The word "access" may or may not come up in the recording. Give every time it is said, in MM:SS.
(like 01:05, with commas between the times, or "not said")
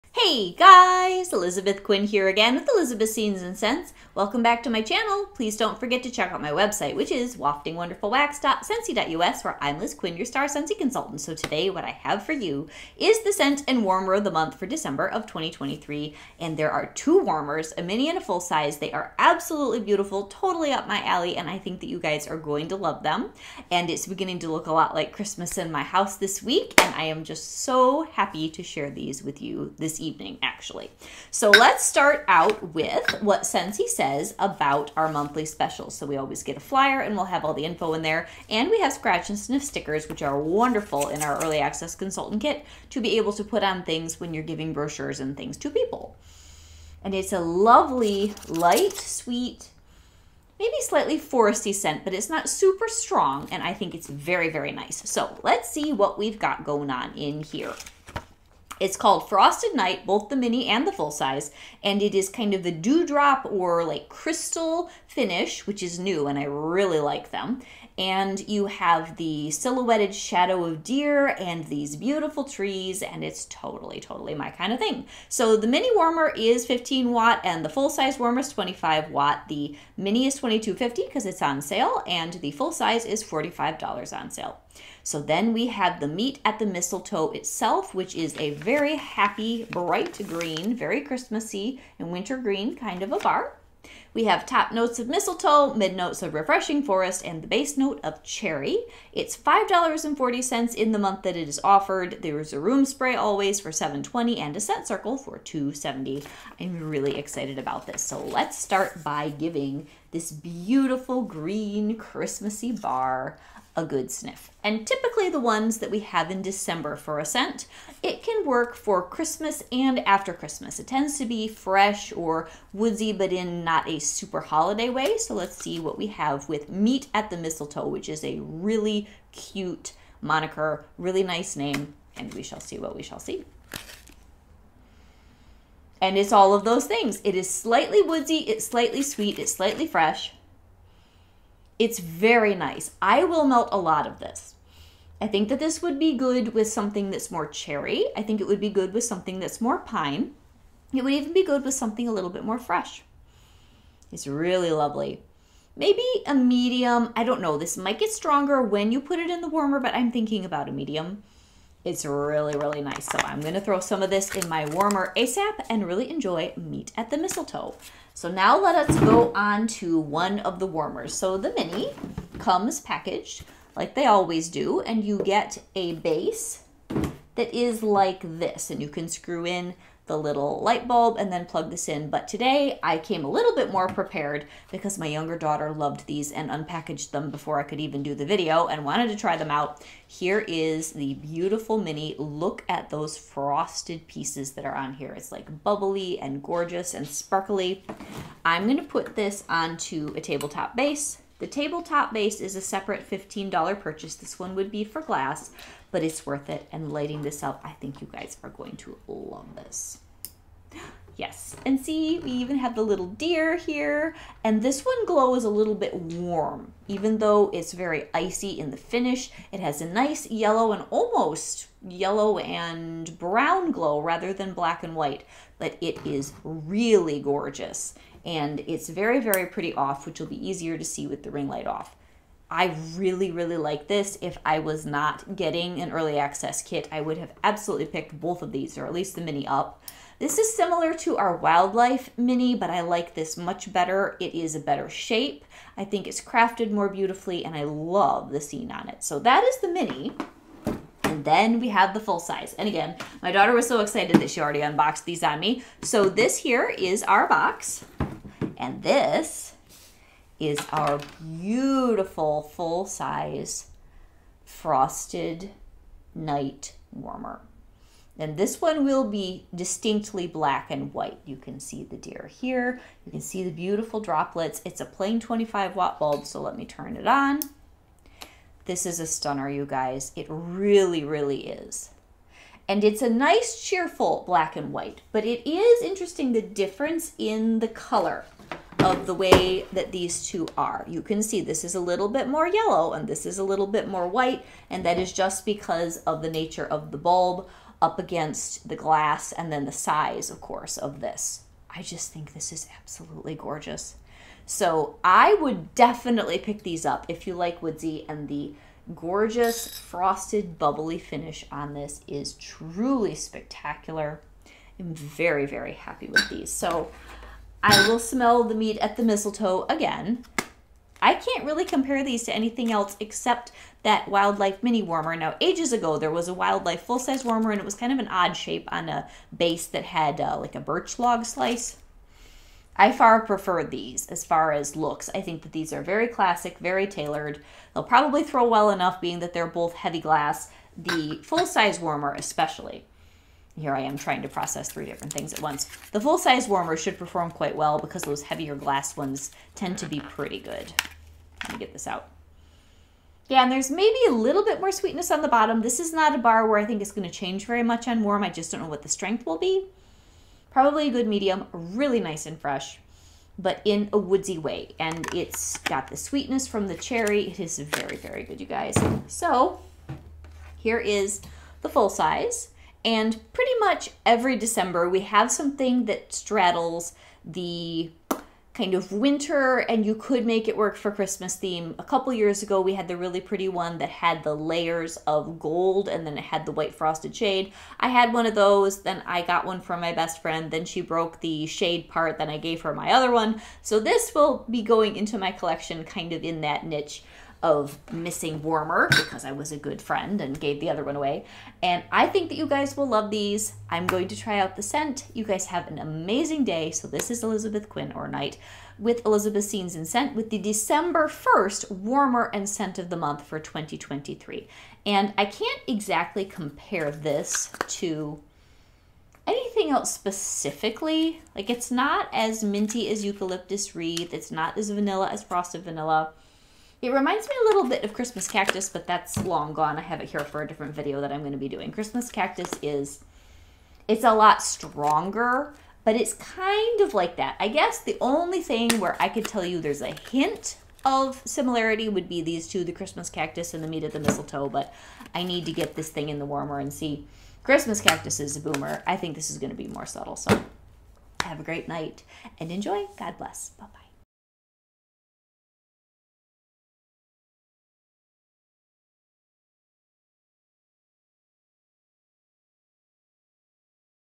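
00:41, 03:56.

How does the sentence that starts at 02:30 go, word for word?
It would even be good with something a little bit more fresh.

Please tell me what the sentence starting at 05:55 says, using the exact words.
This is not a bar where I think it's going to change very much on warm.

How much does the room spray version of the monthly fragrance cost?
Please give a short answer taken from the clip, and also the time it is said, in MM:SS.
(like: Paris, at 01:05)
$7.20, at 01:43.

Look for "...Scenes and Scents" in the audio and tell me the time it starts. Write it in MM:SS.
00:03.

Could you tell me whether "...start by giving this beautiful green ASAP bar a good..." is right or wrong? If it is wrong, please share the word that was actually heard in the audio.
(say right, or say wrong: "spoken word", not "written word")
wrong: "Christmassy", not "ASAP".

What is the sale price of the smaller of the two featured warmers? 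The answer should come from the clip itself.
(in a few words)
22.50.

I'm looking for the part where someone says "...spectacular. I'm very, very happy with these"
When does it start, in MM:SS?
05:13.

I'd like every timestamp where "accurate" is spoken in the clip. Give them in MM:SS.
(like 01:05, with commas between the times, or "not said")
not said.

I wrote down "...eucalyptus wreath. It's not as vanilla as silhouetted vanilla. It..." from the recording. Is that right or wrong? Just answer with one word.
wrong.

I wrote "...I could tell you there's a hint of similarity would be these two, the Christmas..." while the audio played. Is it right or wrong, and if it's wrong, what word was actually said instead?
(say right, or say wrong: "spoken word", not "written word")
right.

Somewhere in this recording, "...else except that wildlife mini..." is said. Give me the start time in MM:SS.
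05:22.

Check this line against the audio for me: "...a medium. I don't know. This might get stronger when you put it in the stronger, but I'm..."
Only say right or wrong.
wrong.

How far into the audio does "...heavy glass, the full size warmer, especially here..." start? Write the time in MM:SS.
05:39.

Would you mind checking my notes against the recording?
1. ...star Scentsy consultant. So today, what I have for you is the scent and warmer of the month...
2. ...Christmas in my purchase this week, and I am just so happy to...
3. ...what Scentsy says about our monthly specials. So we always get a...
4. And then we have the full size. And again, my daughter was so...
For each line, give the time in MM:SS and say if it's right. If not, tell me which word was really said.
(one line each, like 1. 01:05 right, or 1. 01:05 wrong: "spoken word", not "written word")
1. 00:10 right
2. 00:25 wrong: "house", not "purchase"
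3. 00:33 right
4. 04:11 right.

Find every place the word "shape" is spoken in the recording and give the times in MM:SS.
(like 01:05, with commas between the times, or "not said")
04:04, 05:28.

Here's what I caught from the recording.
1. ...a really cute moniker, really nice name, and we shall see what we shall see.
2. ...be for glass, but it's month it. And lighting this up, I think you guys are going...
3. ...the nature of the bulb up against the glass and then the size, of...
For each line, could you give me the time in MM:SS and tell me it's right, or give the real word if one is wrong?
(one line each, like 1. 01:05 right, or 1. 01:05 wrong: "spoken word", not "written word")
1. 02:08 right
2. 03:24 wrong: "worth", not "month"
3. 04:56 right.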